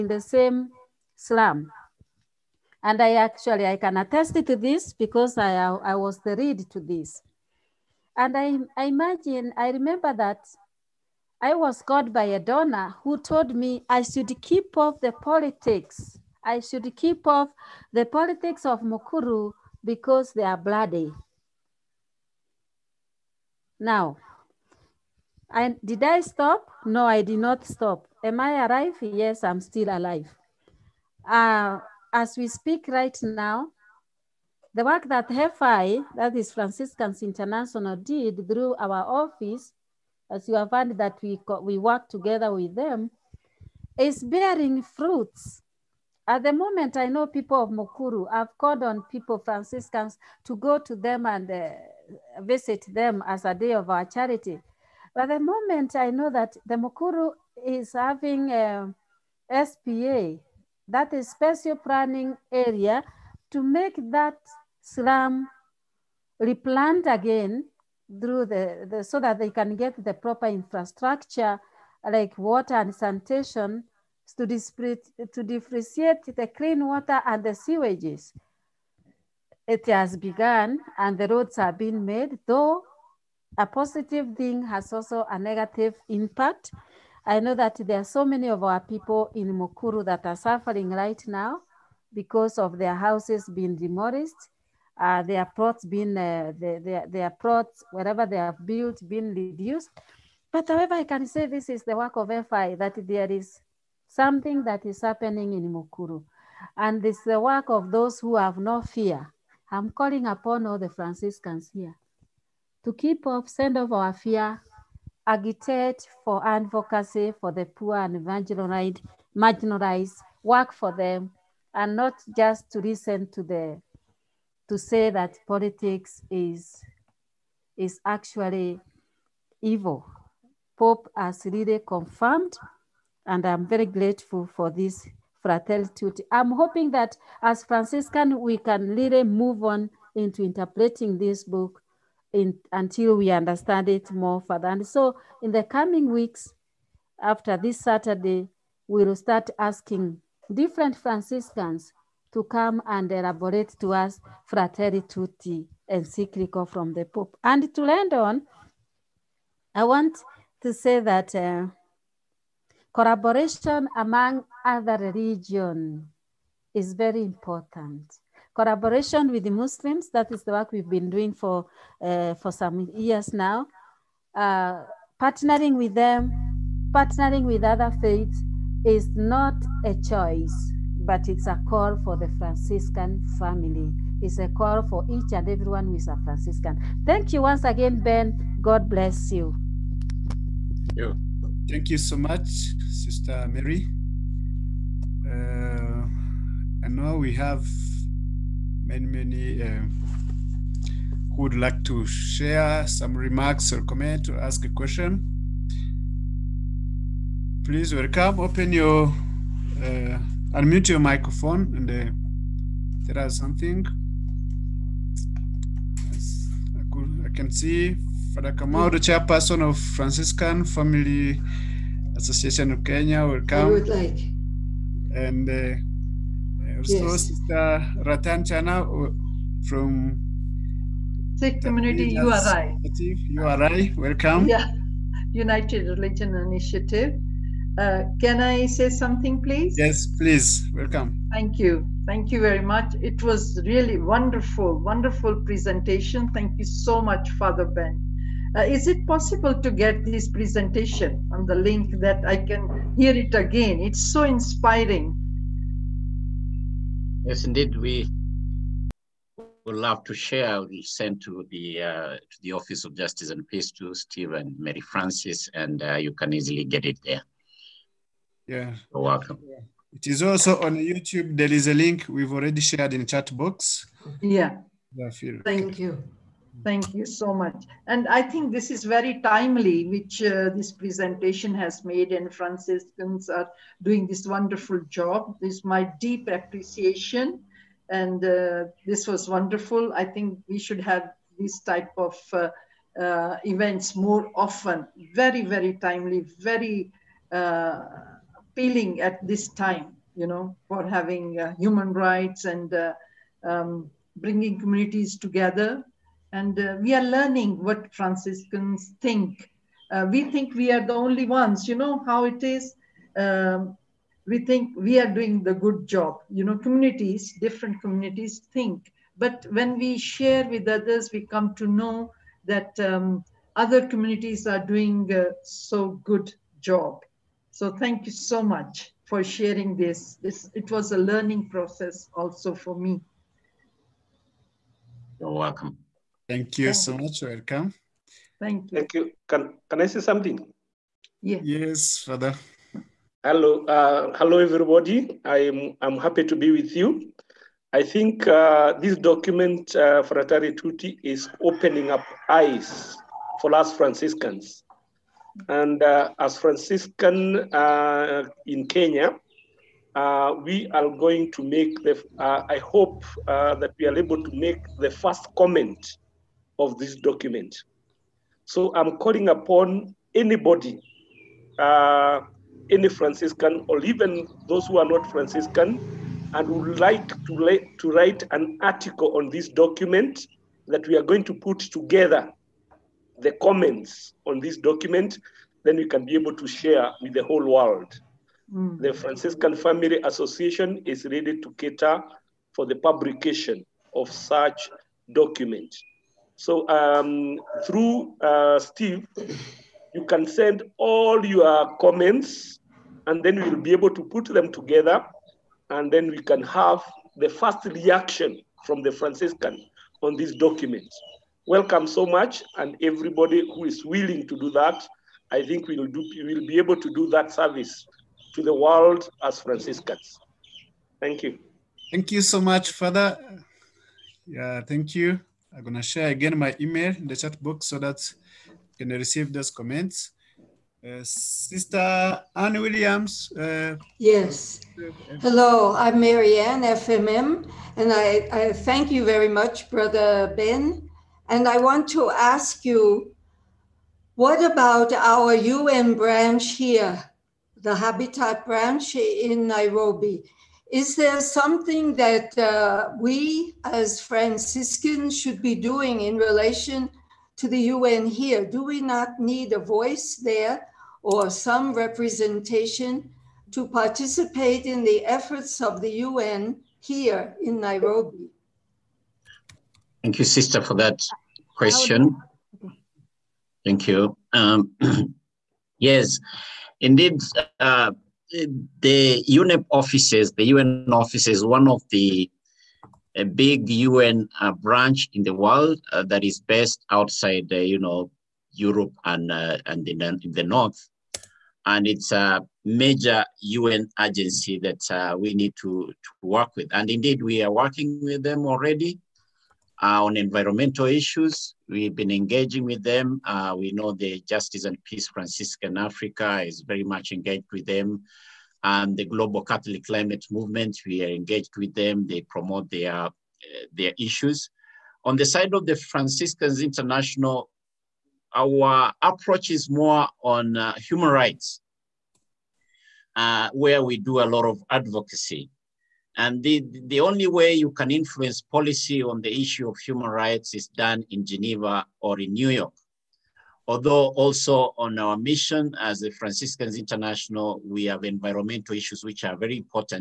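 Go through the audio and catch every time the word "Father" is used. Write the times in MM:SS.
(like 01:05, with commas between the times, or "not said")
03:38, 04:07, 05:41, 07:02.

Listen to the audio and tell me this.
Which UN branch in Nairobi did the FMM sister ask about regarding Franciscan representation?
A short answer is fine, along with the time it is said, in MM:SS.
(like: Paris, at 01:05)
Habitat branch, at 07:27.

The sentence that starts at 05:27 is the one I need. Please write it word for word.
So thank you so much for sharing this.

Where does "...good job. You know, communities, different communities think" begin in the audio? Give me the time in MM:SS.
05:15.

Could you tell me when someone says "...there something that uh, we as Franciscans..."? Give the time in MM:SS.
07:30.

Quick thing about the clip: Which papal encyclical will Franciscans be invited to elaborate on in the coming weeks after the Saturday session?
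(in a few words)
Fratelli Tutti.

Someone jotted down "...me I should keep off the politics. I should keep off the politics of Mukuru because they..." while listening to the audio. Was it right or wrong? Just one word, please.
right.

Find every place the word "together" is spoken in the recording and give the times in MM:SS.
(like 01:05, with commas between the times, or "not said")
00:42, 05:05, 06:21, 06:44.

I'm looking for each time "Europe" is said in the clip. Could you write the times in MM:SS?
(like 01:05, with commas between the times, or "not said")
08:08.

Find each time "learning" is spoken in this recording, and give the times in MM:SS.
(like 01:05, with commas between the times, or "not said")
05:07, 05:30.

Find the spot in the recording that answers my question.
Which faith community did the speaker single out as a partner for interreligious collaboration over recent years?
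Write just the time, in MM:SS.
02:49.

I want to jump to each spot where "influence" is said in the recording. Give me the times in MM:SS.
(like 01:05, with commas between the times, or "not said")
08:47.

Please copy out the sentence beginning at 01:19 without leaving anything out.
It has begun and the roads have been made, though a positive thing has also a negative impact.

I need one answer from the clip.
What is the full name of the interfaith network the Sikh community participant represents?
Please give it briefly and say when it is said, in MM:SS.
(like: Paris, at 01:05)
United Religion Initiative, at 03:55.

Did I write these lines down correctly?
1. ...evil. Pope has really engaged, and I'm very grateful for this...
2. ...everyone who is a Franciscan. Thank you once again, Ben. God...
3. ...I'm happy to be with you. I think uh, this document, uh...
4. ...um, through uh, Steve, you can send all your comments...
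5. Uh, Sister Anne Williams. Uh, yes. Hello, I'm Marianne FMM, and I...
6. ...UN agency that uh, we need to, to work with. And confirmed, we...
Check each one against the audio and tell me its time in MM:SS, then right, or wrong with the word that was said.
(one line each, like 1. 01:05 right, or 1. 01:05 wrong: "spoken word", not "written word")
1. 02:09 wrong: "confirmed", not "engaged"
2. 03:05 right
3. 05:45 right
4. 06:36 right
5. 07:10 right
6. 08:13 wrong: "indeed", not "confirmed".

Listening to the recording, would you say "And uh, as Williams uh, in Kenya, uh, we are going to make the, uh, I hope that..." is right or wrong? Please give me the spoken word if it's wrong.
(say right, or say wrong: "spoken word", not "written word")
wrong: "Franciscan", not "Williams".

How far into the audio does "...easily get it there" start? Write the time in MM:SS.
04:26.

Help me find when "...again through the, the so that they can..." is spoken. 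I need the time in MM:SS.
01:07.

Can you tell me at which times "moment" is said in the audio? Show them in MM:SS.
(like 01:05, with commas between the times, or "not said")
00:46, 00:55.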